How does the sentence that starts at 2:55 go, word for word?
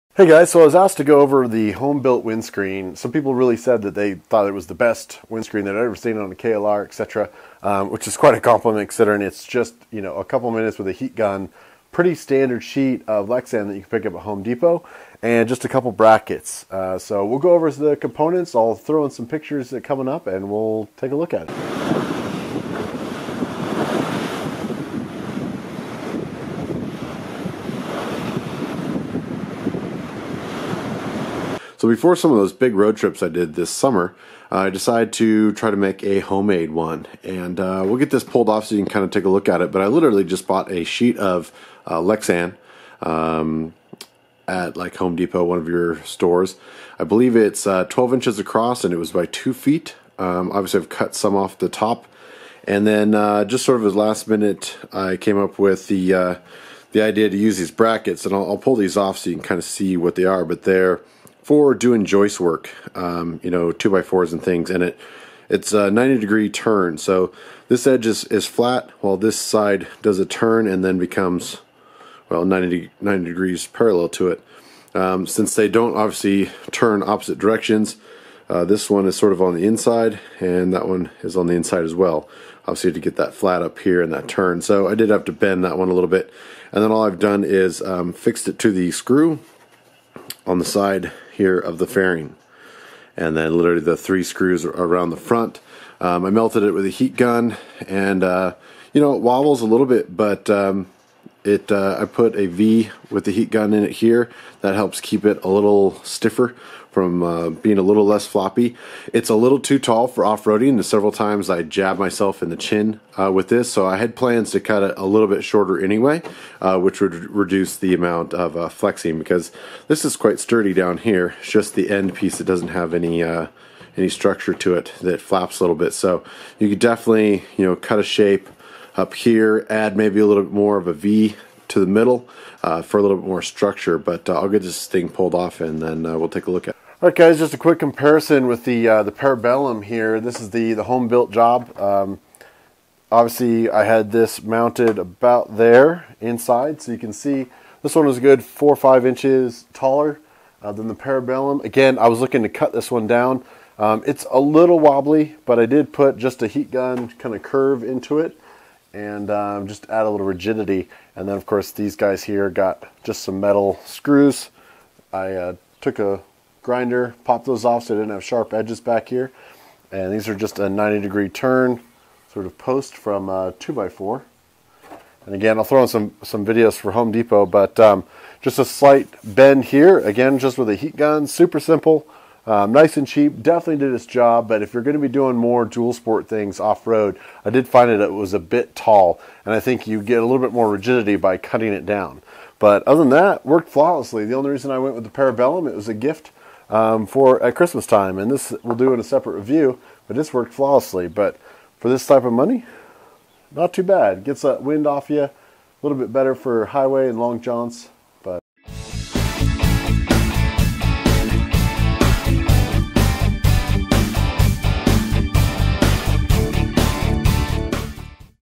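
And again, I'll throw in some, some videos for Home Depot, but um, just a slight bend here.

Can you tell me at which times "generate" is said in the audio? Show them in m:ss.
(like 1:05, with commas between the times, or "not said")
not said.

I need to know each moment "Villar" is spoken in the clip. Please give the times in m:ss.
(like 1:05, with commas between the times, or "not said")
not said.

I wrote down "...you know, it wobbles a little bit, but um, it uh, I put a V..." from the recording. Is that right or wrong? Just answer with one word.
right.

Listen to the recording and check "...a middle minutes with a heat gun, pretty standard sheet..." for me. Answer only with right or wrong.
wrong.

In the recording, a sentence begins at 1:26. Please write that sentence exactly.
And then all I've done is um, fixed it to the screw on the side here of the fairing.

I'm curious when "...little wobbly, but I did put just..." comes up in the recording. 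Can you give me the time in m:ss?
2:34.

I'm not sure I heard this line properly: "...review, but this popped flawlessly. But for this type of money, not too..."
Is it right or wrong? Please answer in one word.
wrong.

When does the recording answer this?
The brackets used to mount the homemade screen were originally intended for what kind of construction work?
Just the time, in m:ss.
1:02.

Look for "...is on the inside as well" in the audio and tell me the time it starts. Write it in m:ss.
1:21.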